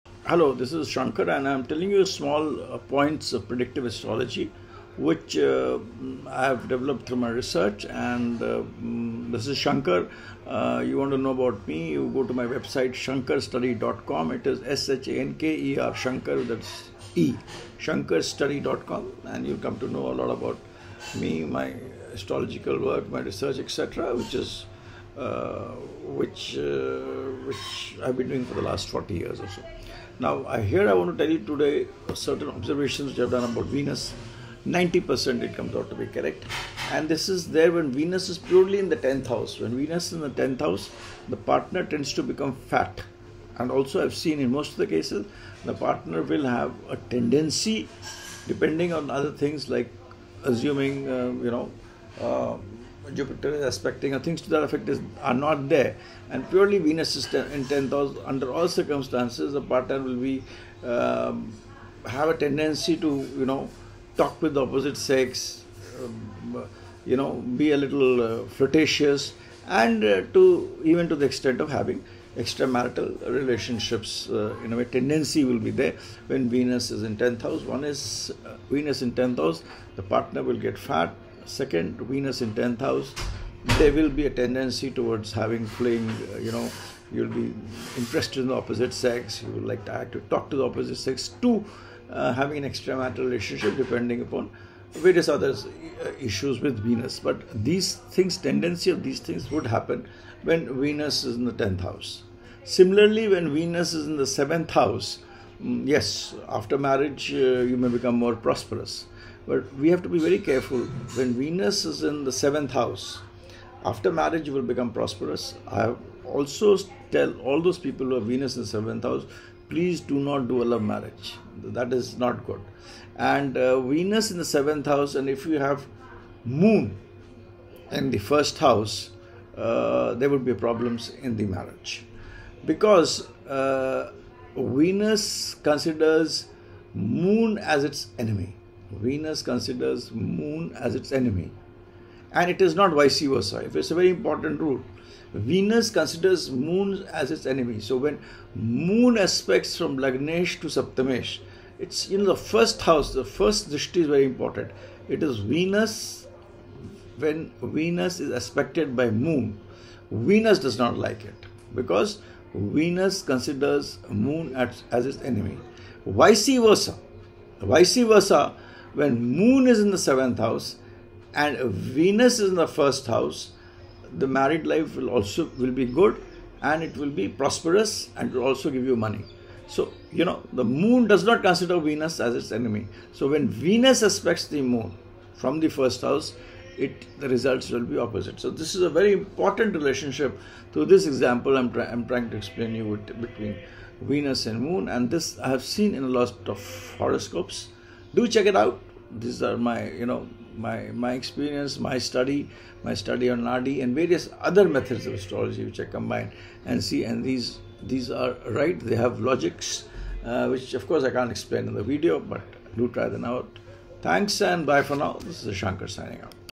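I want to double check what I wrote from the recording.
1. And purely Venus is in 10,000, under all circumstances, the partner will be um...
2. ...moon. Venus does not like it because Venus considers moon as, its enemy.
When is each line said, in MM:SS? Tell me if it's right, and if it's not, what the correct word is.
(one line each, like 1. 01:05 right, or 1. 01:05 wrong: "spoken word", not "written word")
1. 00:56 right
2. 02:39 right.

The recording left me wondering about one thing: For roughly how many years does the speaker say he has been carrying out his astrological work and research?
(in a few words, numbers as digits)
40 years.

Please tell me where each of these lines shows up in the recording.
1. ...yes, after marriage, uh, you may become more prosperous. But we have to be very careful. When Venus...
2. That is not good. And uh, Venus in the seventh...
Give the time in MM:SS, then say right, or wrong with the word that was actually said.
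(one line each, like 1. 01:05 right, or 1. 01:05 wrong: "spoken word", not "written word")
1. 01:45 right
2. 02:01 right.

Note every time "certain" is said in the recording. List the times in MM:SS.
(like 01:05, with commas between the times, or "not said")
00:32.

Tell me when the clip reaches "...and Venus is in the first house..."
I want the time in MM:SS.
02:51.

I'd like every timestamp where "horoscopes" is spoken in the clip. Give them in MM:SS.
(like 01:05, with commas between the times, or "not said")
03:16.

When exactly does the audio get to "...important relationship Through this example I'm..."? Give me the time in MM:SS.
03:09.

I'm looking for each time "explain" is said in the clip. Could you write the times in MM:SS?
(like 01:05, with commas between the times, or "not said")
03:12, 03:31.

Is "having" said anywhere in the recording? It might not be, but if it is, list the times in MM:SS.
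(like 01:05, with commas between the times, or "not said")
01:11, 01:25, 01:32.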